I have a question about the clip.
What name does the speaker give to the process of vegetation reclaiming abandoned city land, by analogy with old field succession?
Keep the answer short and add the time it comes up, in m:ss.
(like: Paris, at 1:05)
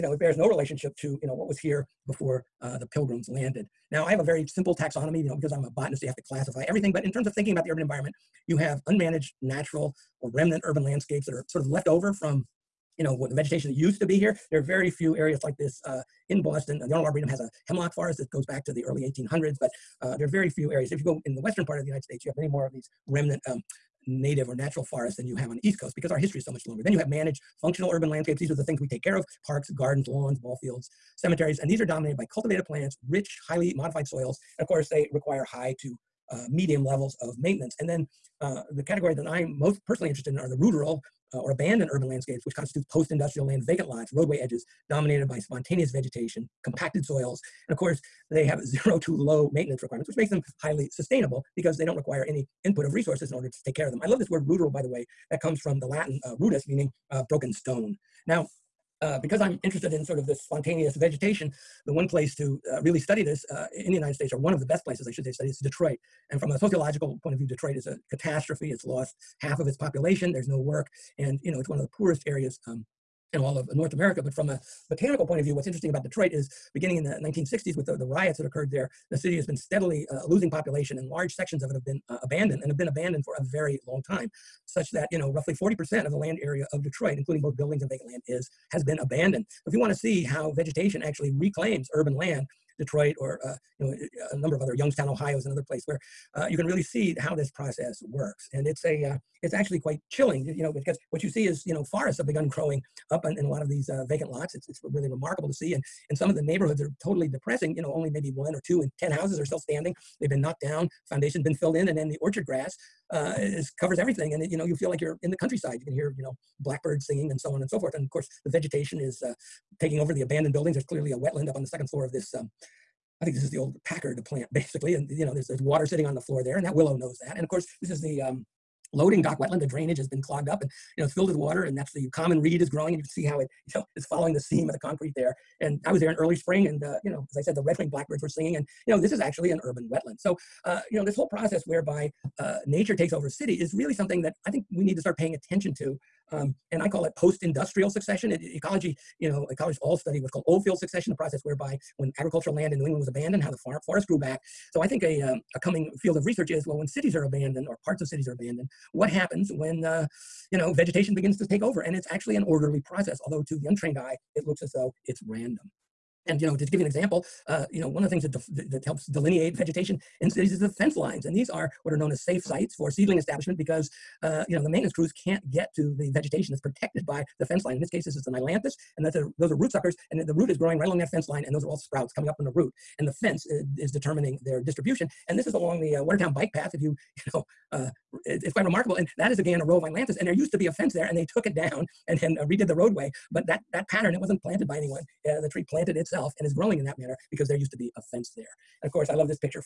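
post-industrial succession, at 2:27.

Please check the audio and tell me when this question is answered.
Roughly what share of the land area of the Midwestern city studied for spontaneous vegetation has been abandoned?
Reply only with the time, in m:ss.
1:25.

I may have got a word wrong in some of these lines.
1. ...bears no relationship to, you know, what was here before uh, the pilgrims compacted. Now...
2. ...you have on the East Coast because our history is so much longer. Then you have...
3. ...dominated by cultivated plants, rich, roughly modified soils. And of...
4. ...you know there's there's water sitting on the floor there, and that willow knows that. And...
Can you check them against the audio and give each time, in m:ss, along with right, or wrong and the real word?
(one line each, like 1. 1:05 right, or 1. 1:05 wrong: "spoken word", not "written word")
1. 0:00 wrong: "landed", not "compacted"
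2. 0:25 right
3. 0:31 wrong: "highly", not "roughly"
4. 2:05 right.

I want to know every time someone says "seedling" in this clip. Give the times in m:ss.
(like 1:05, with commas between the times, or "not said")
2:52.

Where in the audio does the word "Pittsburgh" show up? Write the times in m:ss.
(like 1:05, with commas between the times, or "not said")
not said.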